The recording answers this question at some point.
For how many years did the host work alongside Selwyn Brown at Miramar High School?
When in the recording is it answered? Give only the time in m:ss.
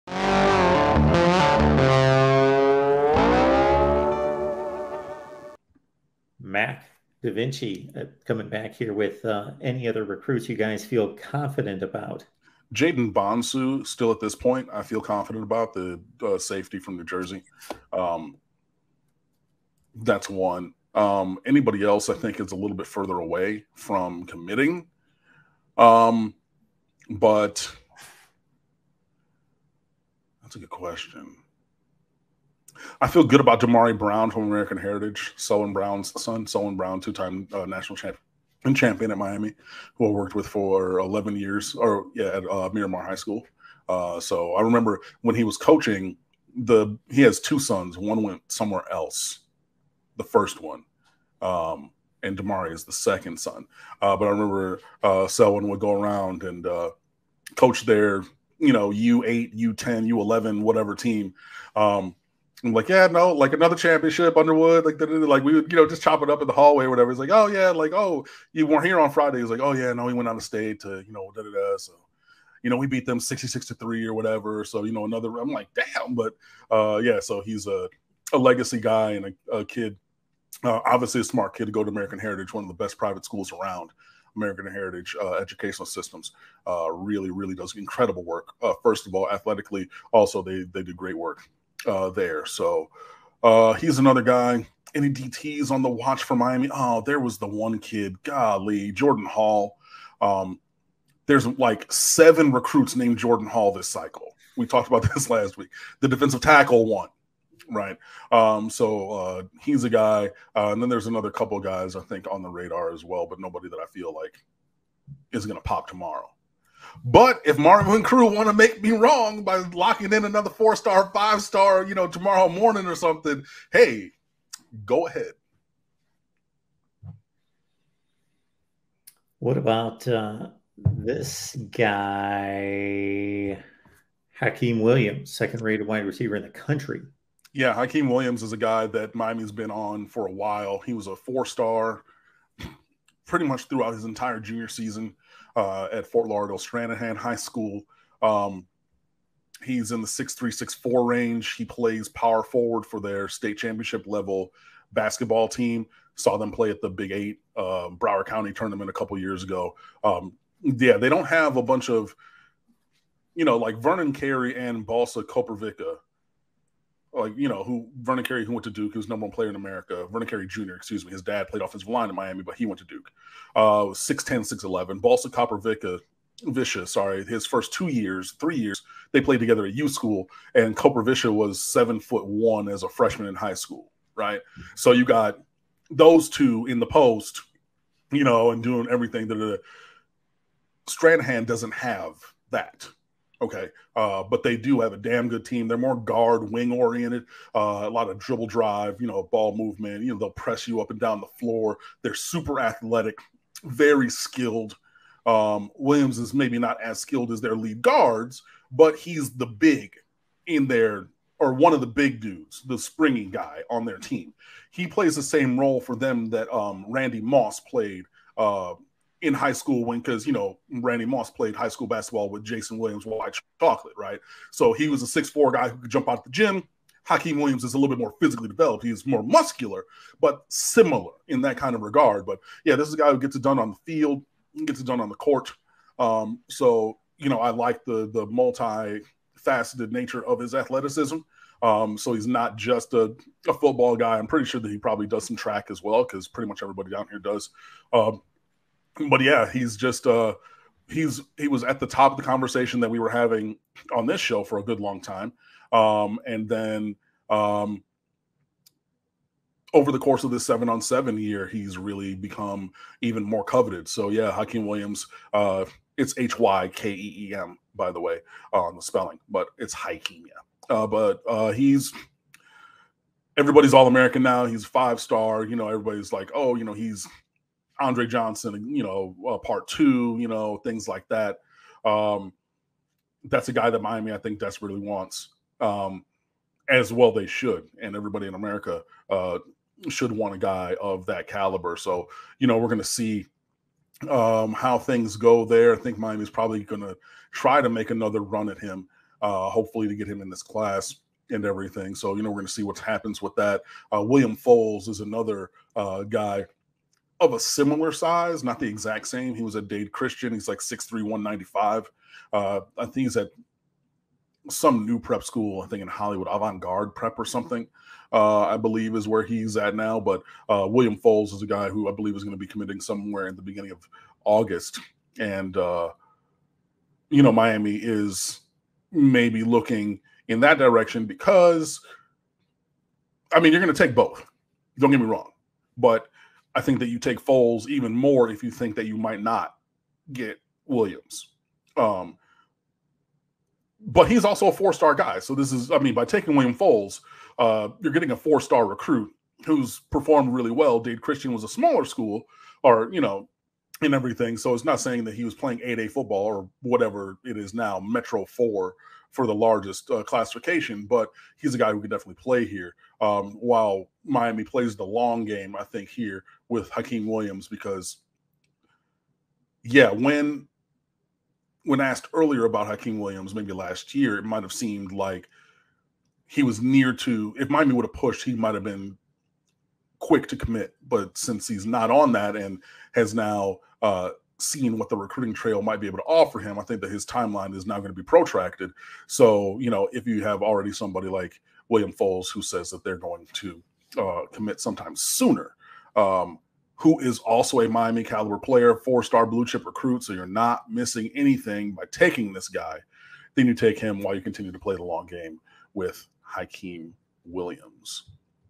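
0:40.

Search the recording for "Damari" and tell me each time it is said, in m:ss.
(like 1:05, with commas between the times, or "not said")
0:33, 0:52.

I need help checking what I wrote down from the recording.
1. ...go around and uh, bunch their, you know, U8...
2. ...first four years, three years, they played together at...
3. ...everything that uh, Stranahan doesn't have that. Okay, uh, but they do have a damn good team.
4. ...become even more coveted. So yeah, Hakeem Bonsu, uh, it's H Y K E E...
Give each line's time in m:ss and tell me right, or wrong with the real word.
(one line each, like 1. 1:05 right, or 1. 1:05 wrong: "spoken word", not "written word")
1. 0:55 wrong: "coach", not "bunch"
2. 2:57 wrong: "two", not "four"
3. 3:08 right
4. 4:22 wrong: "Williams", not "Bonsu".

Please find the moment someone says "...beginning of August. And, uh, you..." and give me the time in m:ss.
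5:23.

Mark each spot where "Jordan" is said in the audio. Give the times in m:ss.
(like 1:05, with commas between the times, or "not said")
1:38, 1:43.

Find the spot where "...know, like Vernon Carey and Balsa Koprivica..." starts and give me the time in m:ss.
2:43.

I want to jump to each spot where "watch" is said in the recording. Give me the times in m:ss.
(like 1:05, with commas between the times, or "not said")
1:35.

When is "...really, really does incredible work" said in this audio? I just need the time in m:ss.
1:26.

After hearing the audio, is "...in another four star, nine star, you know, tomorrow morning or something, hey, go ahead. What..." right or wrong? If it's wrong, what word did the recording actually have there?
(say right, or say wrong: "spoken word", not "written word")
wrong: "five", not "nine".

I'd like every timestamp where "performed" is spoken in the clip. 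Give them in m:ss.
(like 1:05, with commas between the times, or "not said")
5:49.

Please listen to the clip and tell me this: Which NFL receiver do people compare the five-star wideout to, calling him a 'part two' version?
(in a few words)
Andre Johnson.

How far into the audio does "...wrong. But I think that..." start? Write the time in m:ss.
5:35.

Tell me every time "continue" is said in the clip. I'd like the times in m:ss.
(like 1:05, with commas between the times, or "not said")
6:44.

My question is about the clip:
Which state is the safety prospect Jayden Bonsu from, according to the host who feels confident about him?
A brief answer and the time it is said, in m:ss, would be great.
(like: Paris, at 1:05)
New Jersey, at 0:16.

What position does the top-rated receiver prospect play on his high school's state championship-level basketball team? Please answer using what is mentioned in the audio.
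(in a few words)
Power forward.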